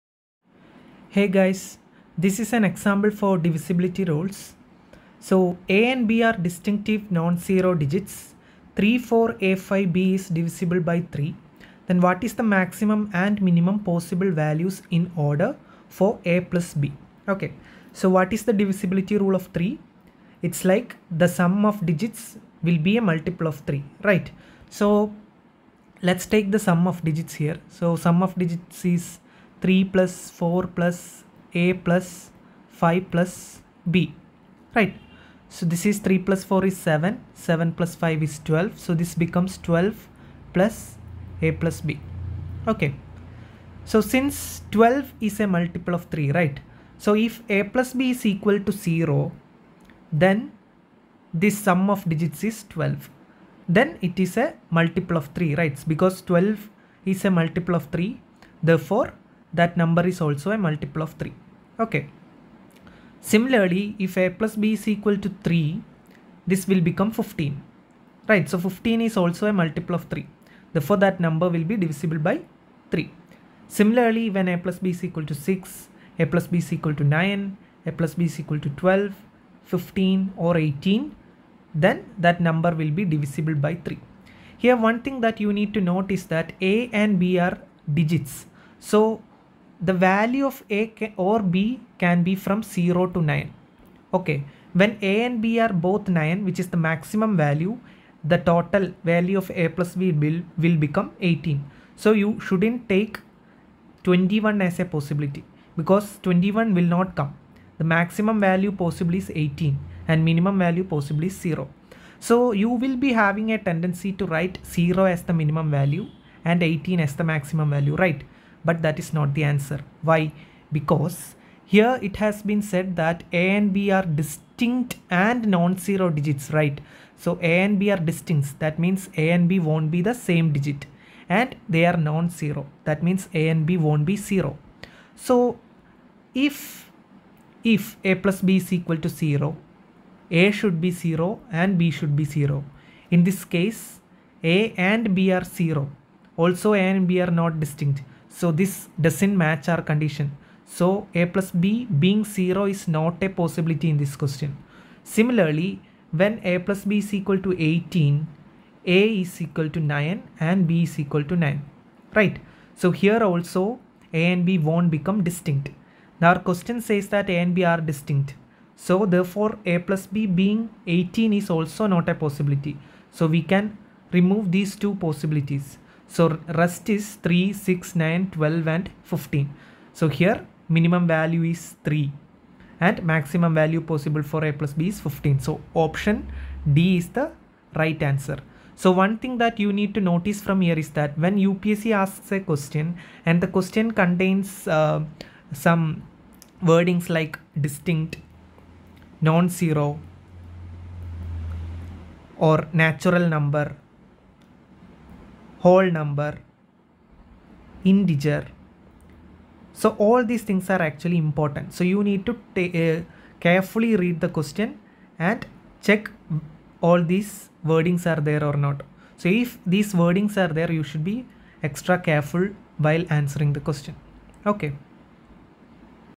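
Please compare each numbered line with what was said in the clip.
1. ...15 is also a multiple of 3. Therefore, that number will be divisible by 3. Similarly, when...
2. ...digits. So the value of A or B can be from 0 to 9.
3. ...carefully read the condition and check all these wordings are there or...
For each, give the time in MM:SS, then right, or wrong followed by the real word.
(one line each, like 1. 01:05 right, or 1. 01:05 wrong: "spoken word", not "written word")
1. 01:08 right
2. 01:27 right
3. 03:33 wrong: "question", not "condition".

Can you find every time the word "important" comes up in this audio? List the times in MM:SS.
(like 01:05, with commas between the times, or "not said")
03:31.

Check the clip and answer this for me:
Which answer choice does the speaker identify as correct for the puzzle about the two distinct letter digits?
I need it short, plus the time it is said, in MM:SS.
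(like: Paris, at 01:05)
Option D, at 03:05.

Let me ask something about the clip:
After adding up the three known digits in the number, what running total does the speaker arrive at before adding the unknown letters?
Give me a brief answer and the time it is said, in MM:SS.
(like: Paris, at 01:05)
12, at 00:39.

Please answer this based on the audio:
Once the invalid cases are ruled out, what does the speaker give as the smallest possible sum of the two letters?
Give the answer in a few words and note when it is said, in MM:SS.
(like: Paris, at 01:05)
3, at 03:00.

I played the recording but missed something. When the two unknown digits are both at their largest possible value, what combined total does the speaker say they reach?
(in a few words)
18.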